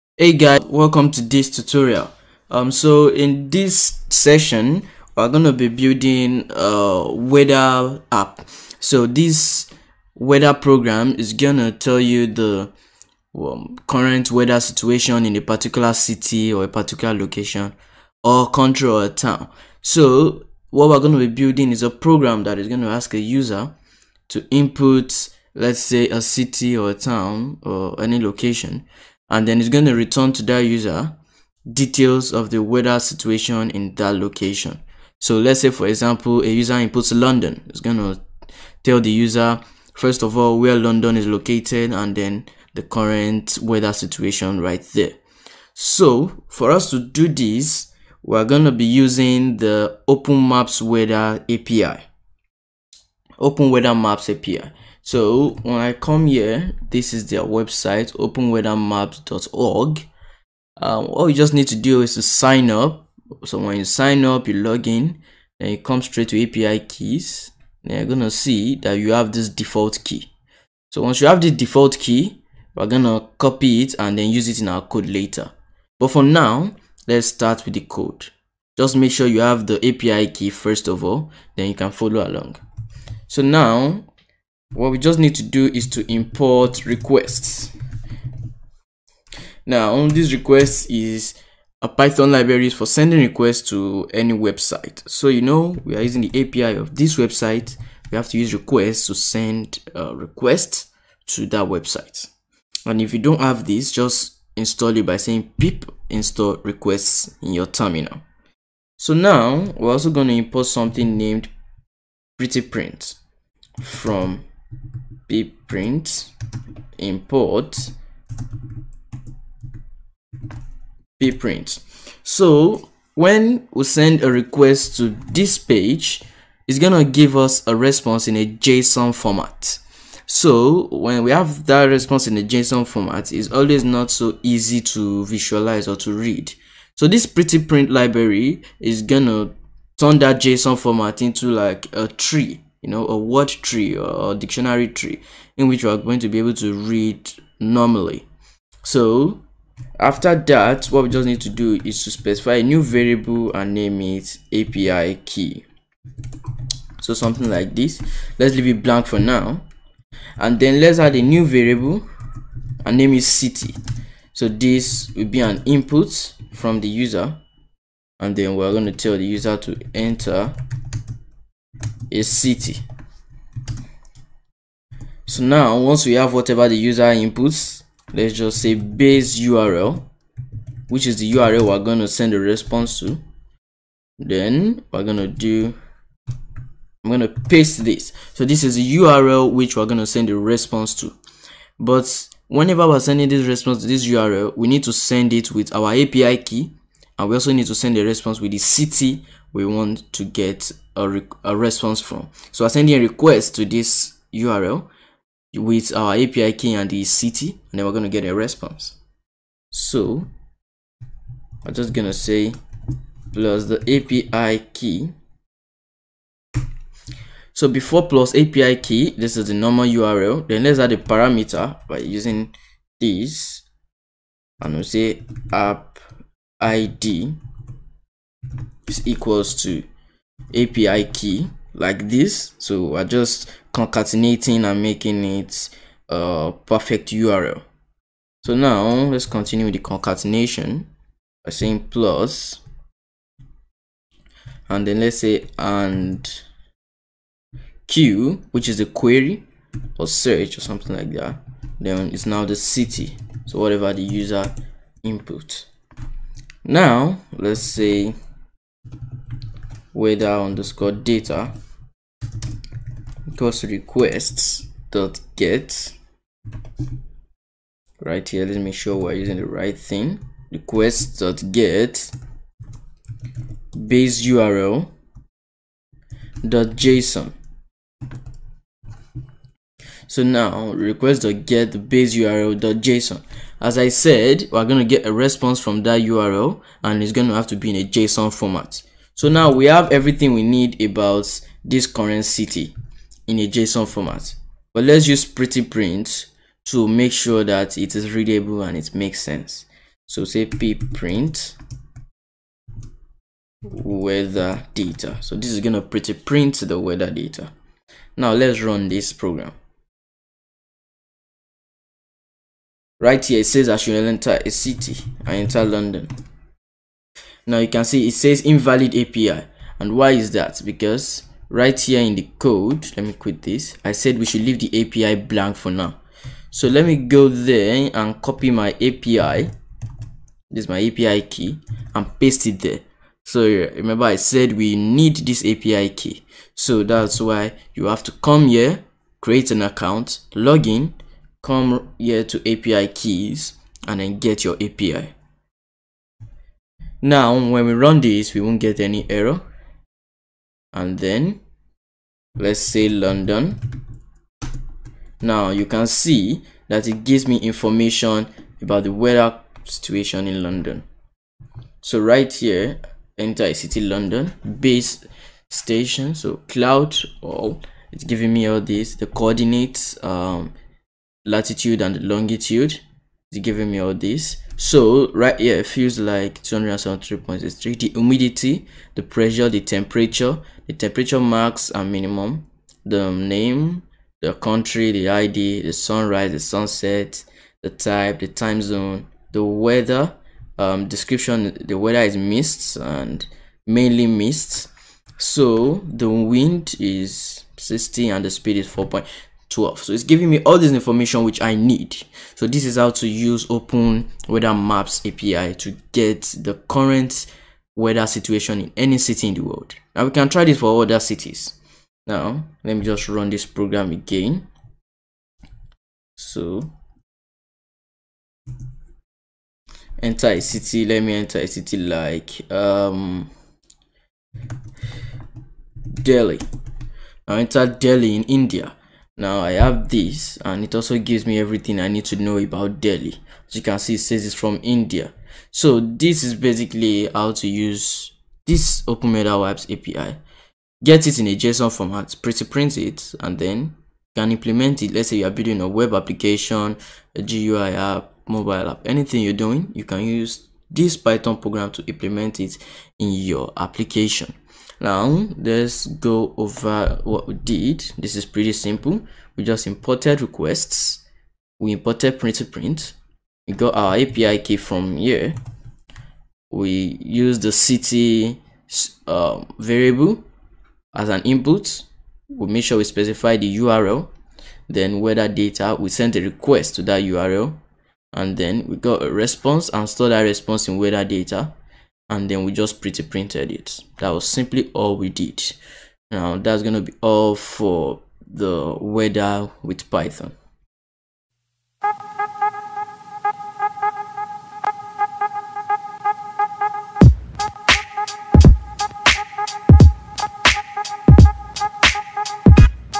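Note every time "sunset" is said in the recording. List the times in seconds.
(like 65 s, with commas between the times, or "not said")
386 s.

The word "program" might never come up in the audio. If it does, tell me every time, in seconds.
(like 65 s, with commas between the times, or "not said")
10 s, 21 s, 309 s, 413 s, 451 s.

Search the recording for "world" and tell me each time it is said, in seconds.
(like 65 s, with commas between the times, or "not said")
409 s.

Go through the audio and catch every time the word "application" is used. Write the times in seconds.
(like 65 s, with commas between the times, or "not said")
445 s, 453 s.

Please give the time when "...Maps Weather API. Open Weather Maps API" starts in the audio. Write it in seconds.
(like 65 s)
50 s.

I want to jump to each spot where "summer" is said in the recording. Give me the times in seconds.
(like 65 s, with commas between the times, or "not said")
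not said.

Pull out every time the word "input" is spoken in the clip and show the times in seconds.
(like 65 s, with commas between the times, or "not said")
24 s, 36 s, 165 s, 177 s, 255 s, 471 s.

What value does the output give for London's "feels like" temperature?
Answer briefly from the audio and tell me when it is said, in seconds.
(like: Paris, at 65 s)
273.63, at 376 s.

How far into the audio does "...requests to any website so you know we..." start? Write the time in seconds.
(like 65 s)
93 s.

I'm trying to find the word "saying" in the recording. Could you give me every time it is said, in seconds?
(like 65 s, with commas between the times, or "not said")
105 s, 241 s.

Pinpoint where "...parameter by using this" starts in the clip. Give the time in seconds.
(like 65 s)
220 s.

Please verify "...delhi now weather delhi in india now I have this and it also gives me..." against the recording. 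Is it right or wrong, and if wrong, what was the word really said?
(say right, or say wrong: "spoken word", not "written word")
wrong: "enter", not "weather".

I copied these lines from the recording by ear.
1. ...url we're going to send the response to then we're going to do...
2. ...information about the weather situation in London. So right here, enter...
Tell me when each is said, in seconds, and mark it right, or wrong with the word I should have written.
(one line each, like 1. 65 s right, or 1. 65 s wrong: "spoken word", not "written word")
1. 181 s right
2. 357 s right.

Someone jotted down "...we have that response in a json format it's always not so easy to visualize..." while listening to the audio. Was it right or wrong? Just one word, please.
right.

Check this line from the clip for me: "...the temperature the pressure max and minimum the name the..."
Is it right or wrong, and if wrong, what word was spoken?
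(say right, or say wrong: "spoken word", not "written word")
wrong: "temperature", not "pressure".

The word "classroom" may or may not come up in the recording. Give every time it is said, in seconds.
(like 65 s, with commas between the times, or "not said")
not said.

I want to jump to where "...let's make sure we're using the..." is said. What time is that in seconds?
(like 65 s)
268 s.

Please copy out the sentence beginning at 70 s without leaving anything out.
So once you have the default key, we're gonna copy it and then use it in our code later.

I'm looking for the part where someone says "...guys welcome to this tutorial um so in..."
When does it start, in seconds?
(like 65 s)
0 s.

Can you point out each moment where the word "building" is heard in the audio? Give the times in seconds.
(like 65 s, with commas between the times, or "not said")
5 s, 21 s, 445 s.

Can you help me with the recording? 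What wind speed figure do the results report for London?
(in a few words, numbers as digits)
4.12.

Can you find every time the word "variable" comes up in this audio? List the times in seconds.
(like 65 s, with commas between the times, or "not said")
152 s, 161 s, 469 s.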